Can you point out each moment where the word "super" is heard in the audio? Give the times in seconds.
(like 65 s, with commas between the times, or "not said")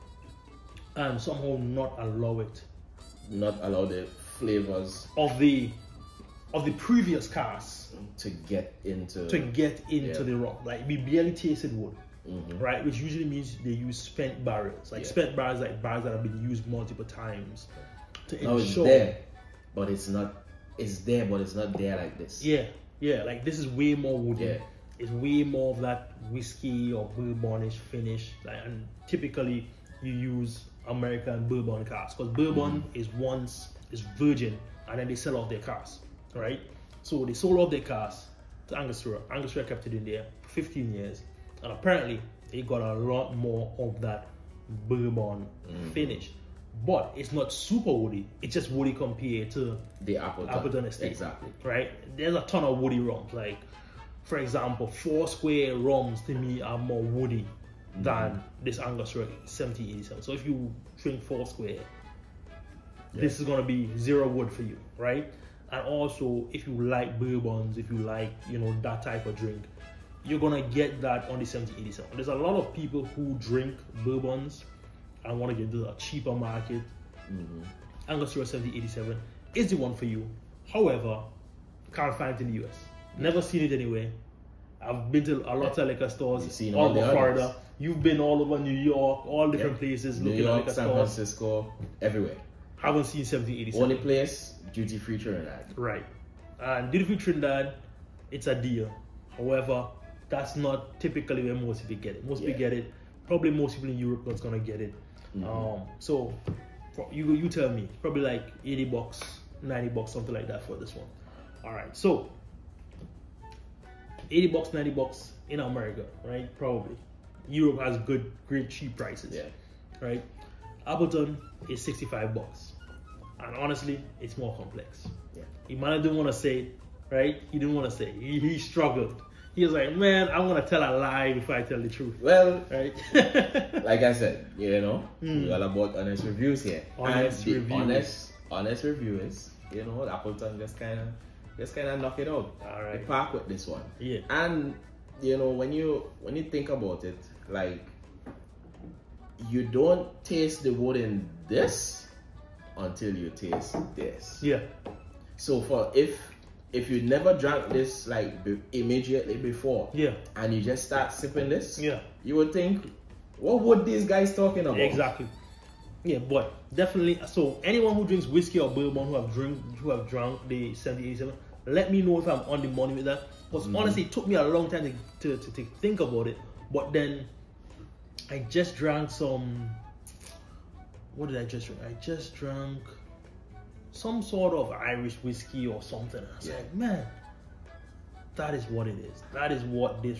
47 s.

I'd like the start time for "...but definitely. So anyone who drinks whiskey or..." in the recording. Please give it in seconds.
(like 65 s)
166 s.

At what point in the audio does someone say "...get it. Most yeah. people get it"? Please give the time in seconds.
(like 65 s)
102 s.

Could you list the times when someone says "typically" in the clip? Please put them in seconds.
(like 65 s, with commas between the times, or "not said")
29 s, 101 s.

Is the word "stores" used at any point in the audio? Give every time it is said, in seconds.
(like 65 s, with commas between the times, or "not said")
86 s, 90 s.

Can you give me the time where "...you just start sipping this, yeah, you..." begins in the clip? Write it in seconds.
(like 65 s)
160 s.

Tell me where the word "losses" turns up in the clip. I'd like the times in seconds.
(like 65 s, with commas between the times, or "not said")
not said.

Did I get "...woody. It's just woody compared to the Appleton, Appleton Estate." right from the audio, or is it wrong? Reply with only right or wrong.
right.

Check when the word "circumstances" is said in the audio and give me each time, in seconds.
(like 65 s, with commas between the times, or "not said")
not said.